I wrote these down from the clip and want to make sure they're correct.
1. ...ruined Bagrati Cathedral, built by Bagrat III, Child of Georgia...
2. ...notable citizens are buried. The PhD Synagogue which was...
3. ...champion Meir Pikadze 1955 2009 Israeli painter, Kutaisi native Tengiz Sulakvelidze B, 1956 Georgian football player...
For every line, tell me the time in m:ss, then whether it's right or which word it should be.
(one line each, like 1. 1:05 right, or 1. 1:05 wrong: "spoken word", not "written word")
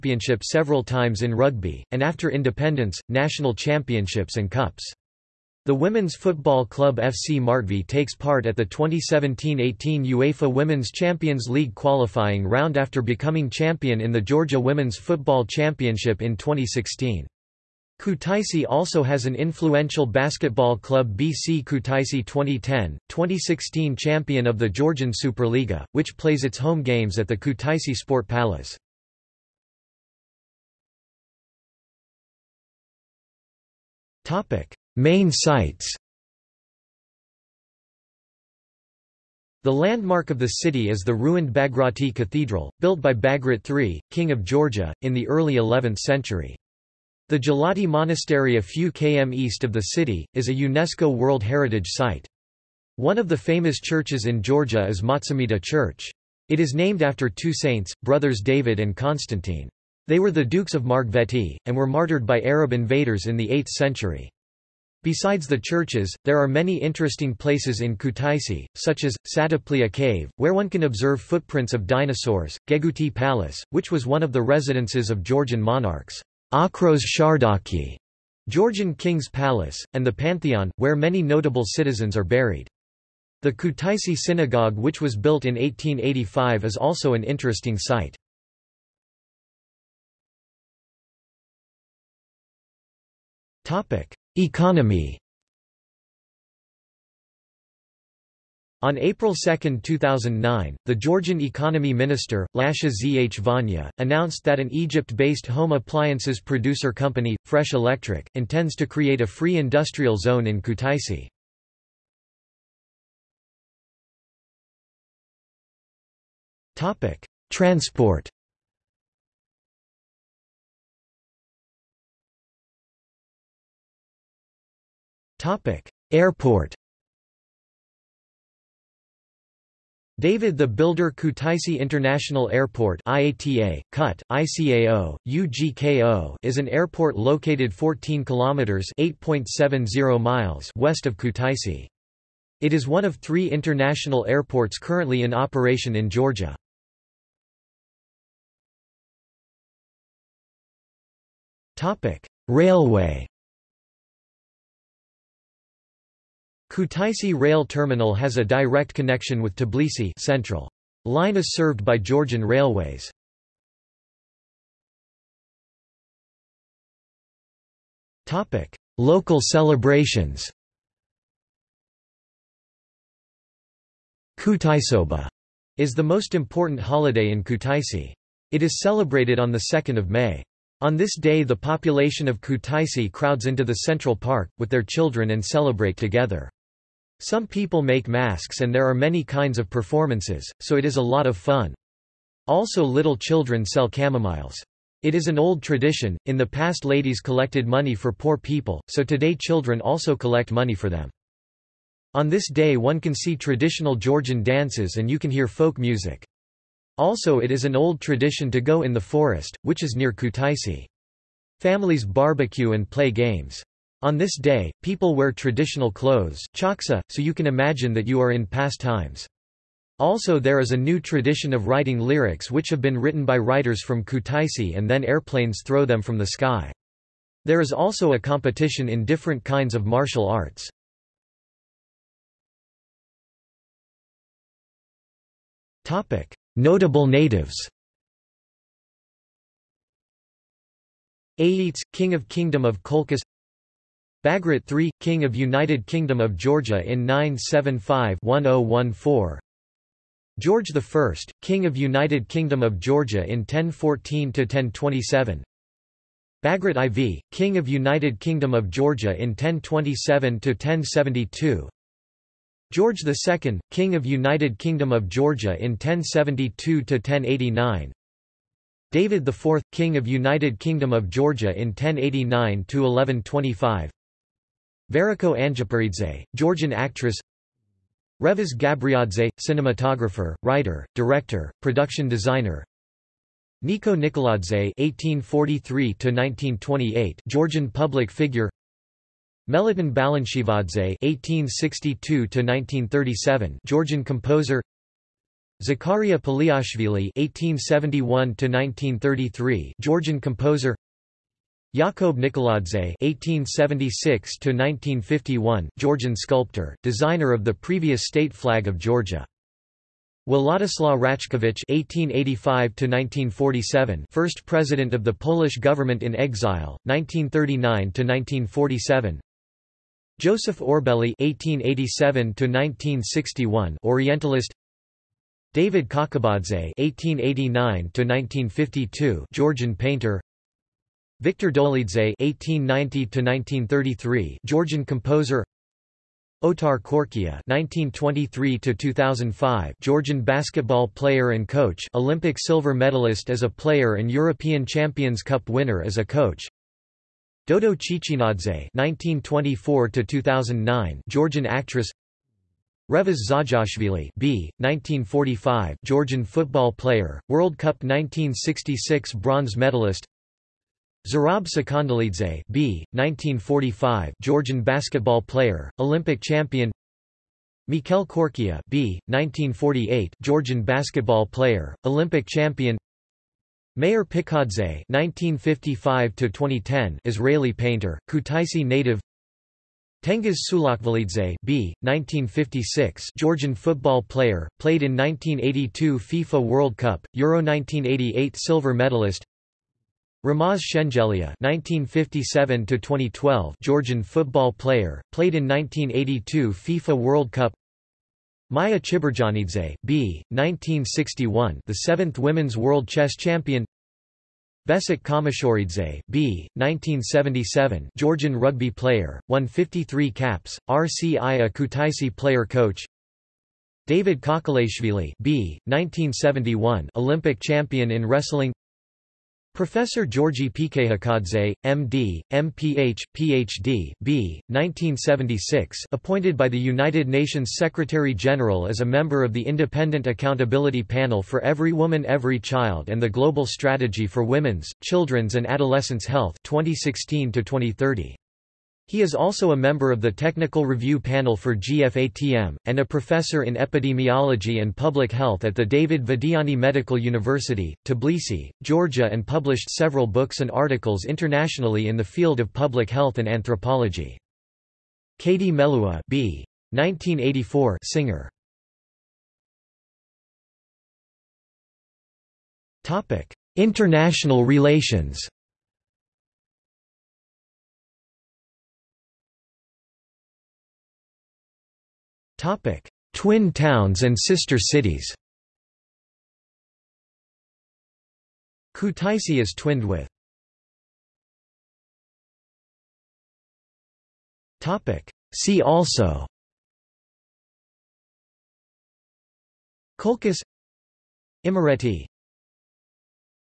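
1. 0:41 wrong: "King", not "Child"
2. 1:21 wrong: "Kutaisi", not "PhD"
3. 6:12 wrong: "2010", not "2009".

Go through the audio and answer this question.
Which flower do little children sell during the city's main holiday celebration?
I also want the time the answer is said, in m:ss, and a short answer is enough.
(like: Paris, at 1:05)
Chamomiles, at 3:13.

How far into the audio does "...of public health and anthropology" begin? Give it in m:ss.
7:32.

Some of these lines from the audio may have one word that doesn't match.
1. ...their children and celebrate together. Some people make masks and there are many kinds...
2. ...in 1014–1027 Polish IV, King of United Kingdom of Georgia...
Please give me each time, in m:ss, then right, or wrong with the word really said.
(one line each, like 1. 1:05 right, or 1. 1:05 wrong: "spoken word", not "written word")
1. 3:04 right
2. 4:13 wrong: "Bagrat", not "Polish".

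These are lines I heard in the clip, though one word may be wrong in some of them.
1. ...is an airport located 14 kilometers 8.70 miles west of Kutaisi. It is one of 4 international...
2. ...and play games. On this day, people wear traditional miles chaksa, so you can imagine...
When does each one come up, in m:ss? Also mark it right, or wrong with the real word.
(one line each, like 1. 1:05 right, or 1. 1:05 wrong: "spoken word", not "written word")
1. 2:16 wrong: "3", not "4"
2. 3:32 wrong: "clothes", not "miles".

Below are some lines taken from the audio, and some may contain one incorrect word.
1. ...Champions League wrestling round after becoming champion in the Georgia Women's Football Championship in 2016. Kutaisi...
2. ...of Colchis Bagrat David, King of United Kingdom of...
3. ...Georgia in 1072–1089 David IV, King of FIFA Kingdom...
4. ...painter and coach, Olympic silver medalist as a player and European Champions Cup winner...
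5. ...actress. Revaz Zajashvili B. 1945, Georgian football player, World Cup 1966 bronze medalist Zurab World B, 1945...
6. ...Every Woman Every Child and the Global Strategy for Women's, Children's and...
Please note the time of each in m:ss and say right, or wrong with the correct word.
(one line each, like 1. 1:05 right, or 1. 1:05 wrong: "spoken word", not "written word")
1. 0:10 wrong: "qualifying", not "wrestling"
2. 4:02 wrong: "III", not "David"
3. 4:25 wrong: "United", not "FIFA"
4. 5:40 wrong: "player", not "painter"
5. 5:51 wrong: "Sakandelidze", not "World"
6. 7:11 right.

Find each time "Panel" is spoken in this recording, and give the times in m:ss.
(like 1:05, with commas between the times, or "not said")
7:10, 7:20.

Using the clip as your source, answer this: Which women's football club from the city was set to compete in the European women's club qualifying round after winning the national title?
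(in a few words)
FC Martvi.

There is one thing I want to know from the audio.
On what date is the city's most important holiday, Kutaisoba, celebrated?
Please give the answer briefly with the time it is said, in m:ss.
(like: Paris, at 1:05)
2 May, at 2:59.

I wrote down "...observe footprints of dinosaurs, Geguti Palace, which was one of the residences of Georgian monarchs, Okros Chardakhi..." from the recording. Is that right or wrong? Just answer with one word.
right.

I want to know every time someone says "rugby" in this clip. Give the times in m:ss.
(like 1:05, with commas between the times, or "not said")
0:01, 6:48.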